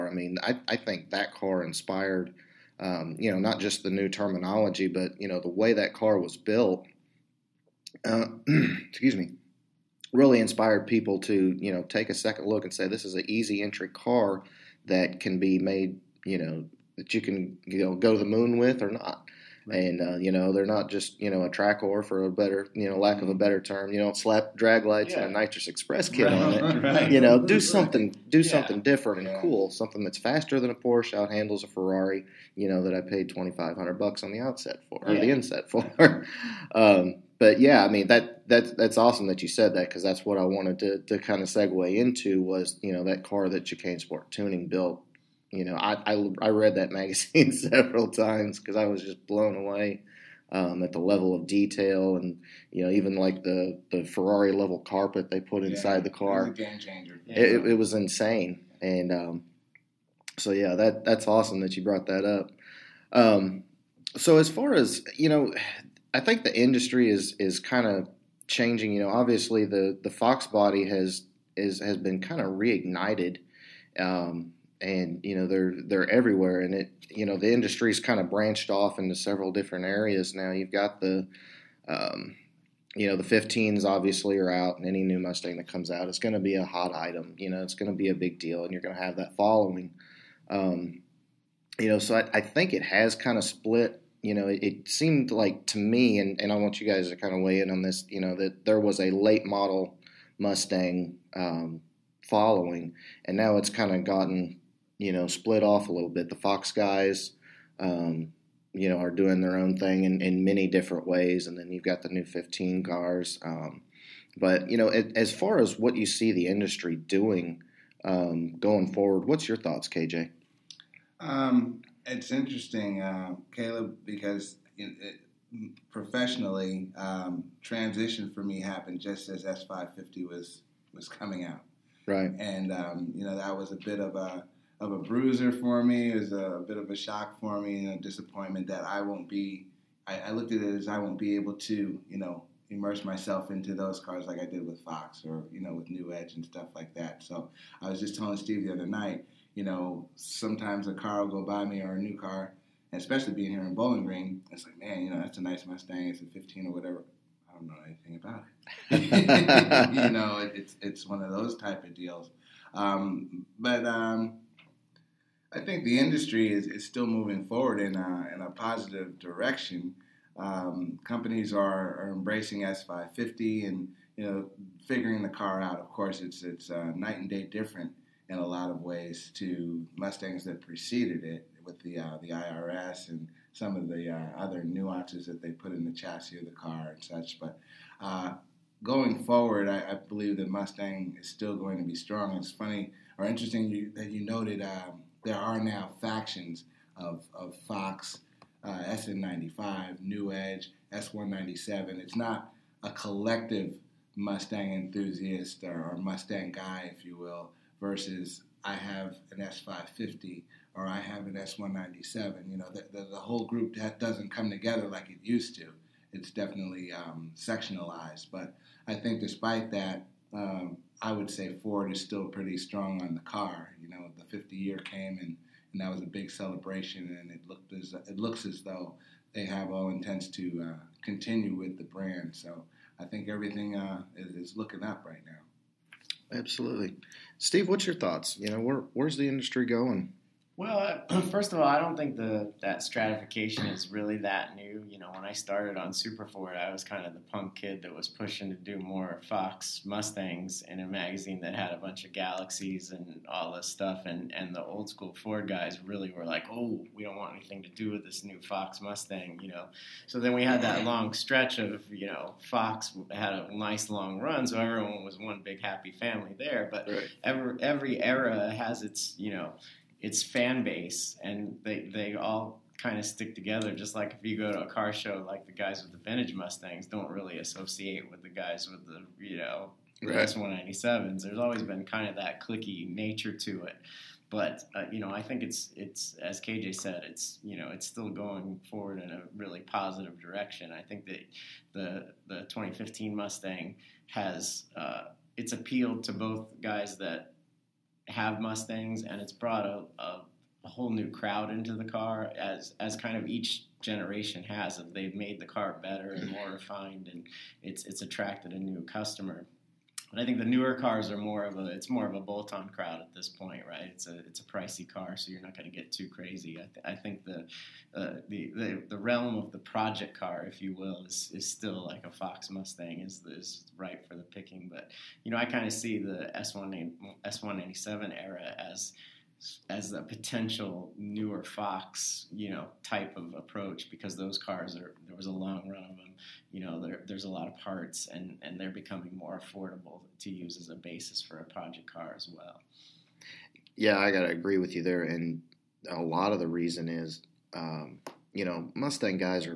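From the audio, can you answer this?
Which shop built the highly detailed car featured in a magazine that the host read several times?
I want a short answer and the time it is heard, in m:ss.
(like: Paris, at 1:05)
Chicane Sport Tuning, at 0:43.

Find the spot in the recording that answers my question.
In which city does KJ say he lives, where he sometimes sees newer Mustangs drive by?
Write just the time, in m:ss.
2:33.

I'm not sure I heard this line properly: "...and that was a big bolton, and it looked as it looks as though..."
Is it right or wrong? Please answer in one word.
wrong.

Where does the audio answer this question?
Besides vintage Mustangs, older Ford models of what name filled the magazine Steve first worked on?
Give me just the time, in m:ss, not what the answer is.
4:12.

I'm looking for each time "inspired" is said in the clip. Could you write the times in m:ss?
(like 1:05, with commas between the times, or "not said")
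0:01, 0:10.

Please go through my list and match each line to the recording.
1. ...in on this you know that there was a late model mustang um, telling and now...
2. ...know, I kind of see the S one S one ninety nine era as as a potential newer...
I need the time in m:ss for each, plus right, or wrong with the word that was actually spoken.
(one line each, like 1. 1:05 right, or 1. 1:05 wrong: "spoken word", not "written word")
1. 1:37 wrong: "following", not "telling"
2. 5:25 wrong: "seven", not "nine".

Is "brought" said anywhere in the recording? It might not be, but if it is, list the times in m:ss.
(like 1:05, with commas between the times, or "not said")
1:01, 4:59.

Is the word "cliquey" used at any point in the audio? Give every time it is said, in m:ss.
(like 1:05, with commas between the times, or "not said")
4:42.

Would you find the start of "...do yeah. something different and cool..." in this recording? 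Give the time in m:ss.
0:28.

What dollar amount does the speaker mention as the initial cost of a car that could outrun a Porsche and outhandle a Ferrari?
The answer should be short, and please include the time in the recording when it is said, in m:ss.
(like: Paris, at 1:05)
2500 bucks, at 0:33.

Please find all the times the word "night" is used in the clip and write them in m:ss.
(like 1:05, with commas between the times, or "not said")
2:28, 2:56.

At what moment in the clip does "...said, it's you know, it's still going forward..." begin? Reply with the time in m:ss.
4:46.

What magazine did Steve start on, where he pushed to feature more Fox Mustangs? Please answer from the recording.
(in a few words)
Super Ford.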